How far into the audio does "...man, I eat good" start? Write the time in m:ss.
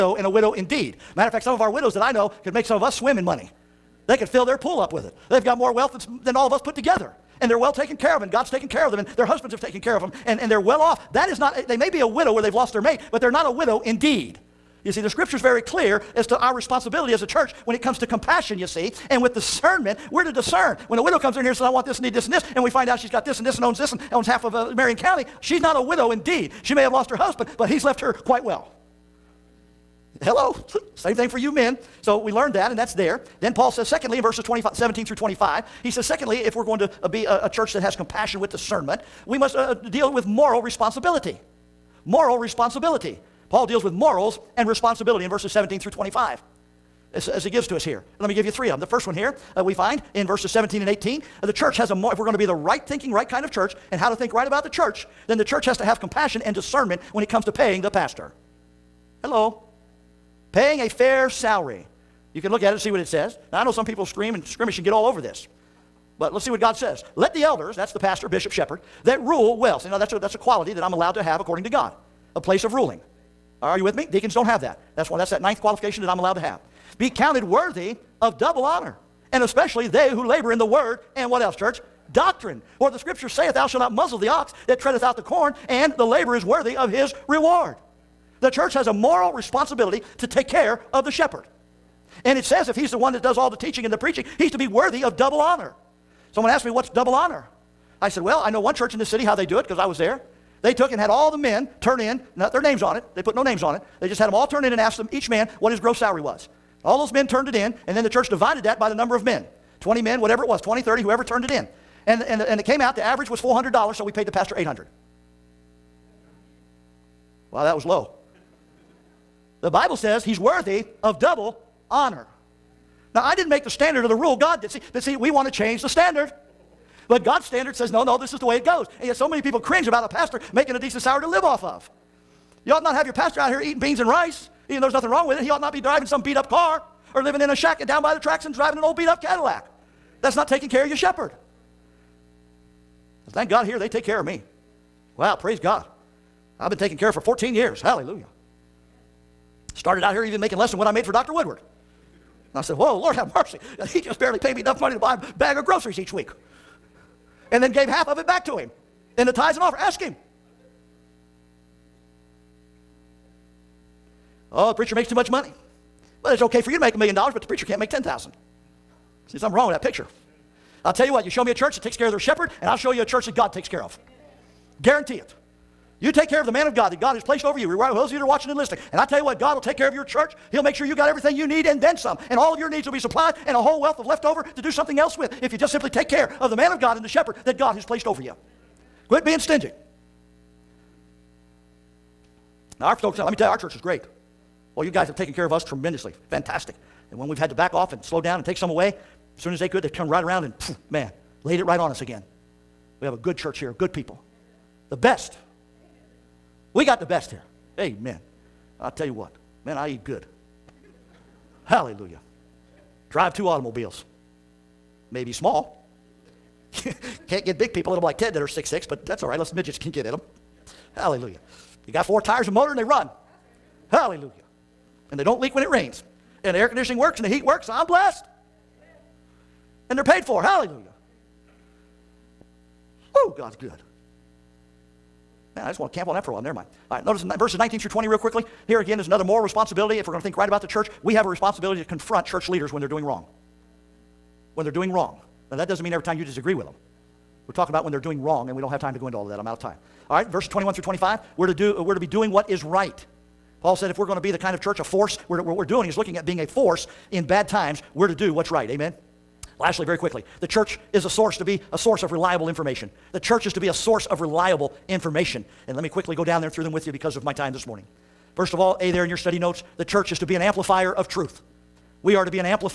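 3:29.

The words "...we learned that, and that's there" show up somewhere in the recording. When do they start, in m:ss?
0:32.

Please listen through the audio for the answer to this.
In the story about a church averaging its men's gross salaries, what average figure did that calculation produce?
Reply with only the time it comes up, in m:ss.
1:53.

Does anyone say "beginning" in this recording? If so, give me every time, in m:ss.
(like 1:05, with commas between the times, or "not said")
not said.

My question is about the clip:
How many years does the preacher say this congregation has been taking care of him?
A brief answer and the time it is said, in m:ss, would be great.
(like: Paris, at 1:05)
14, at 2:27.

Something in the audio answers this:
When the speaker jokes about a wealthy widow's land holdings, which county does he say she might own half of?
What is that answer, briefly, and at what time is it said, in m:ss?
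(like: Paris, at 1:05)
Marion County, at 0:24.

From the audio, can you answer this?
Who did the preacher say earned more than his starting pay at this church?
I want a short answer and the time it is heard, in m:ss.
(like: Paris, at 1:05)
Dr. Woodward, at 2:31.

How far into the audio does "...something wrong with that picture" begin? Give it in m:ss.
2:49.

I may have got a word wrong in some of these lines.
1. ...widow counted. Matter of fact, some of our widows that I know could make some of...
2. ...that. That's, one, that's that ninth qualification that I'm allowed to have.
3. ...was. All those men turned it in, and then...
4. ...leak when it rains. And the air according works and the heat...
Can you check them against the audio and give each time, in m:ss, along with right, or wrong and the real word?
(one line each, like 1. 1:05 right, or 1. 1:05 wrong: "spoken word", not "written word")
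1. 0:00 wrong: "indeed", not "counted"
2. 1:14 right
3. 1:46 right
4. 3:45 wrong: "conditioning", not "according".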